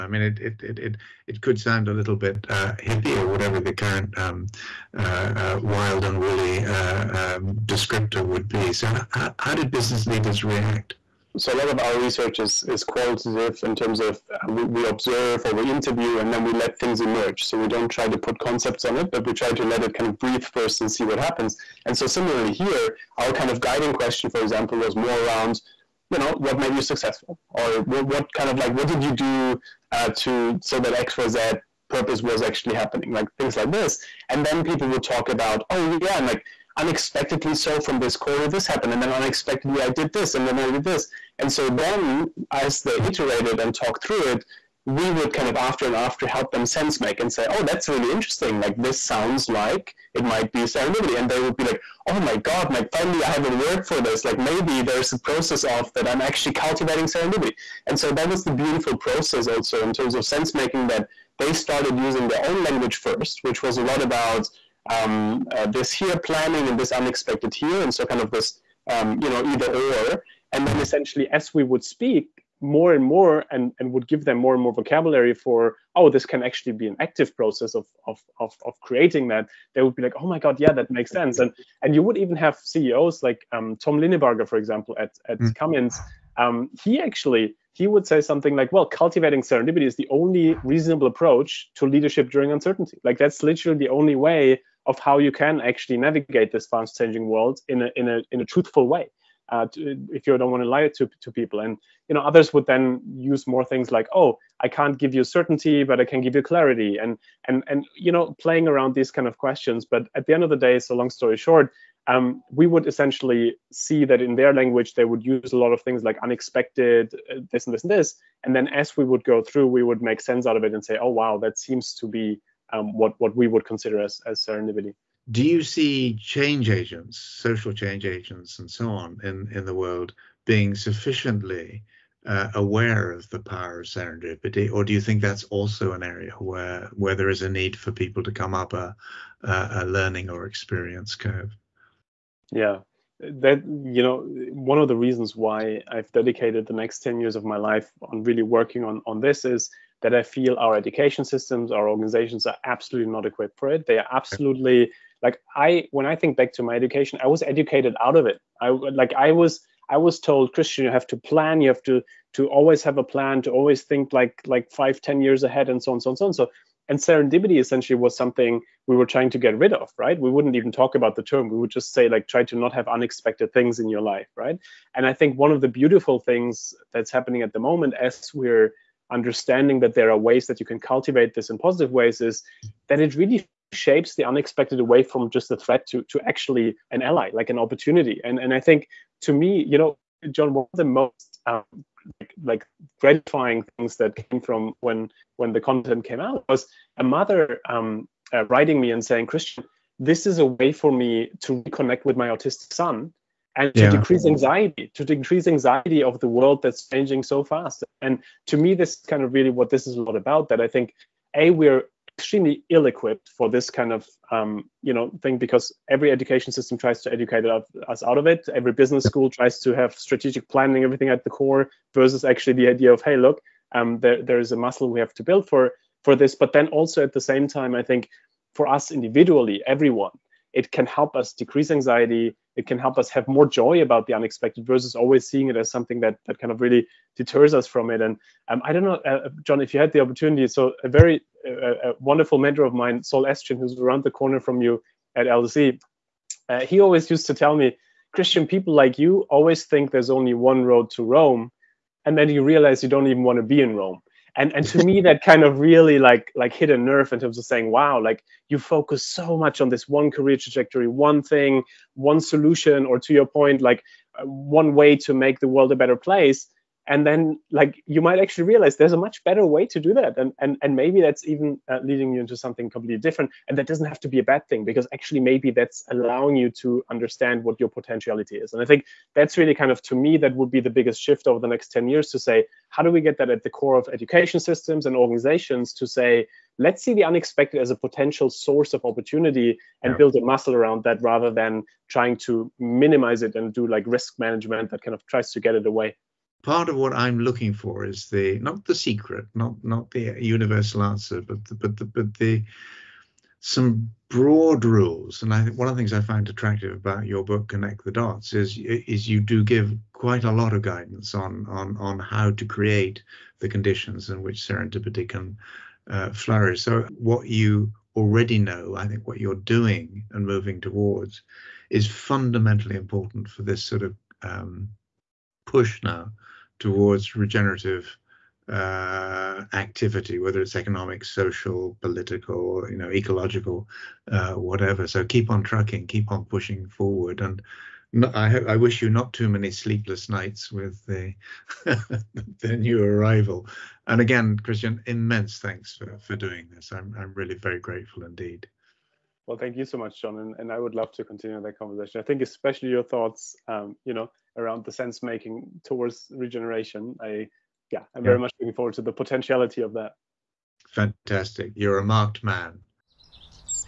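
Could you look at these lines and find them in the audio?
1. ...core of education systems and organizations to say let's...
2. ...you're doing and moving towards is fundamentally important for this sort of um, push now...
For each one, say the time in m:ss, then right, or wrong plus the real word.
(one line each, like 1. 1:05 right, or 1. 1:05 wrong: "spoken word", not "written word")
1. 4:43 right
2. 5:19 right.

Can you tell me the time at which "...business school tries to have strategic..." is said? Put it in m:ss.
3:38.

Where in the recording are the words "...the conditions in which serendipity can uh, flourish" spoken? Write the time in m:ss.
5:13.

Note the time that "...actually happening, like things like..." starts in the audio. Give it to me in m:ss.
0:32.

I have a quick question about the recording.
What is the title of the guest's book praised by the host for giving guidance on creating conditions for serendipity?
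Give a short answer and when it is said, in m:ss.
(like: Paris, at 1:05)
Connect the Dots, at 5:07.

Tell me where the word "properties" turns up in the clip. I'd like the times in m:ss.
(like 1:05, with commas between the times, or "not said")
not said.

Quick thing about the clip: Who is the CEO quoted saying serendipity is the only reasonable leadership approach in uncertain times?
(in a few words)
Tom Linebarger.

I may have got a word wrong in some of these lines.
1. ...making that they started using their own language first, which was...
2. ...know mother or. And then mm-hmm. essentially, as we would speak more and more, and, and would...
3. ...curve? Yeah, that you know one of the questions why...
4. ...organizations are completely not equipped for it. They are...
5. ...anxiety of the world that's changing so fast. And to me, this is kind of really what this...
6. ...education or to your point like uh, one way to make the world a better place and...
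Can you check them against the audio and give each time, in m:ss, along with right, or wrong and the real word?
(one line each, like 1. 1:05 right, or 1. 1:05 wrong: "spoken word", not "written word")
1. 1:00 right
2. 1:09 wrong: "either", not "mother"
3. 2:21 wrong: "reasons", not "questions"
4. 2:31 wrong: "absolutely", not "completely"
5. 3:25 right
6. 4:22 wrong: "solution", not "education".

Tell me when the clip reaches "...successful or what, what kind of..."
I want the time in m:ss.
0:26.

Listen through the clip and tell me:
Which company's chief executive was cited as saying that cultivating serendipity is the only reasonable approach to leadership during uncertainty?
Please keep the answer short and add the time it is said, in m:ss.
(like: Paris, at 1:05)
Cummins, at 1:25.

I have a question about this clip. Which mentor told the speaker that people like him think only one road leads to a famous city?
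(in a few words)
Saul Estrin.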